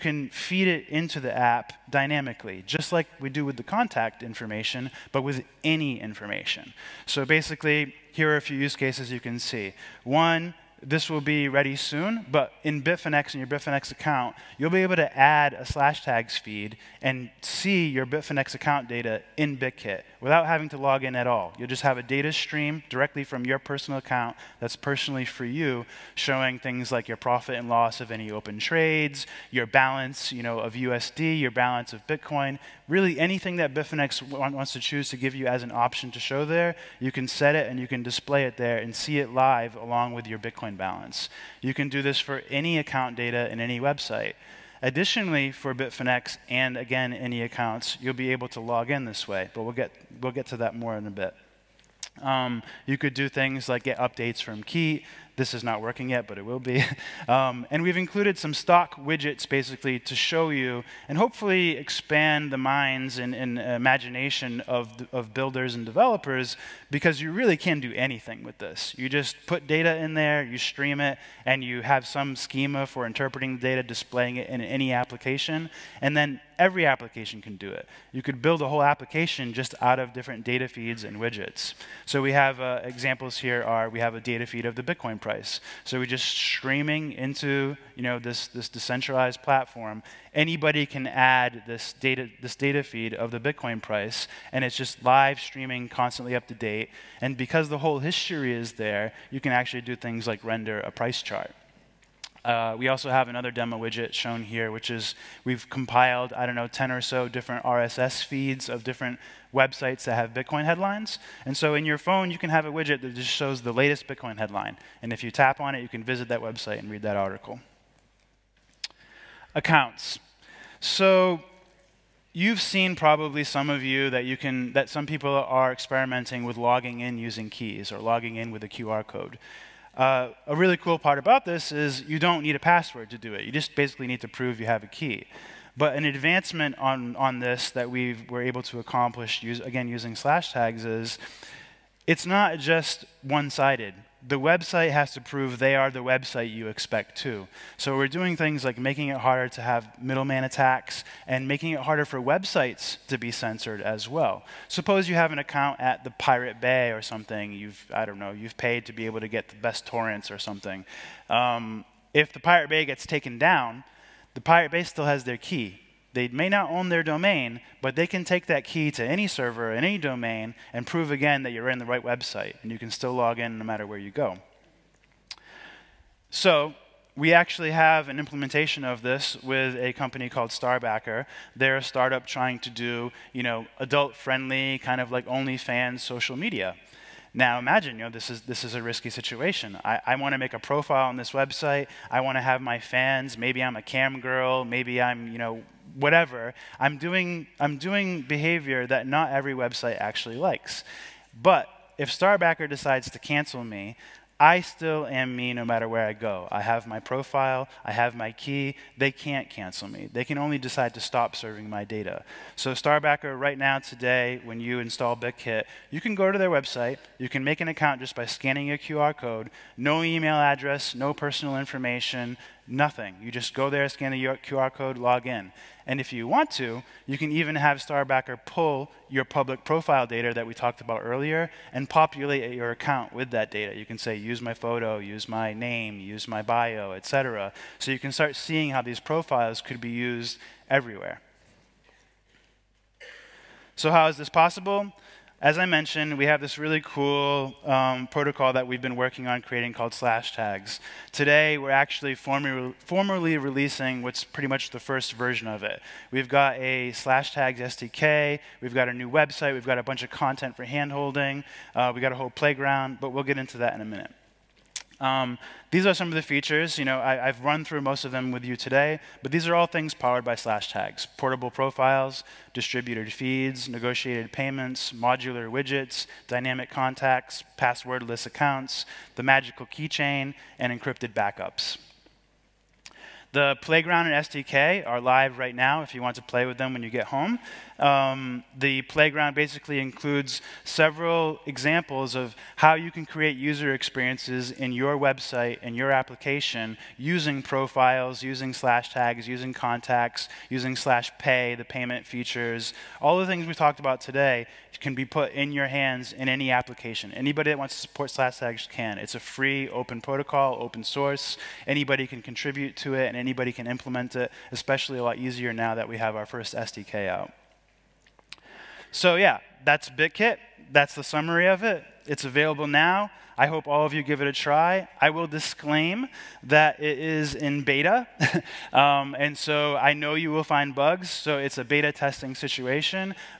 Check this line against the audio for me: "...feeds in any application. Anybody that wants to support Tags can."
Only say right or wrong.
wrong.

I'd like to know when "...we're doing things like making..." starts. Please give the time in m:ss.
2:27.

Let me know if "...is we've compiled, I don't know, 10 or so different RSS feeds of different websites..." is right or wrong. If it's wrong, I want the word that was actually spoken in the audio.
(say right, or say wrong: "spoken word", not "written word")
right.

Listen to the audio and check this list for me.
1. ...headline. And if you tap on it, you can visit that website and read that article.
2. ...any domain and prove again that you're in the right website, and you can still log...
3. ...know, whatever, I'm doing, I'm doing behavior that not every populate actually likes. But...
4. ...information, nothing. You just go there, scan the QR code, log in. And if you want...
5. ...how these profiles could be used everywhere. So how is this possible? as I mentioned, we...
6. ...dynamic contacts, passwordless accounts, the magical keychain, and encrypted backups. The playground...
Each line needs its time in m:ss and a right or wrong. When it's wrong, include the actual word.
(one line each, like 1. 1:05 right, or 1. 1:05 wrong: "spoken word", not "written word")
1. 1:54 right
2. 2:49 right
3. 3:15 wrong: "website", not "populate"
4. 3:41 right
5. 3:58 right
6. 4:36 right.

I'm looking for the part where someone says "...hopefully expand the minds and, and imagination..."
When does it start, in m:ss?
1:01.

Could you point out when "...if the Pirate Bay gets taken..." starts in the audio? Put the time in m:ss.
2:42.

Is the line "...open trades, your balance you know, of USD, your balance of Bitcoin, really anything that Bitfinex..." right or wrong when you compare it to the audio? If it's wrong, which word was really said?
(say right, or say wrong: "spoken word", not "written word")
right.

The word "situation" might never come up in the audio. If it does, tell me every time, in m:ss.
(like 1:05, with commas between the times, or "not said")
3:09, 5:32.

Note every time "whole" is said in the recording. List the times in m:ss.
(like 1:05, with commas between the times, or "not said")
1:18, 1:37, 4:22.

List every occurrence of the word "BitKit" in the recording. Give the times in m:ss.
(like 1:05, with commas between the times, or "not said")
0:19, 3:35, 5:19.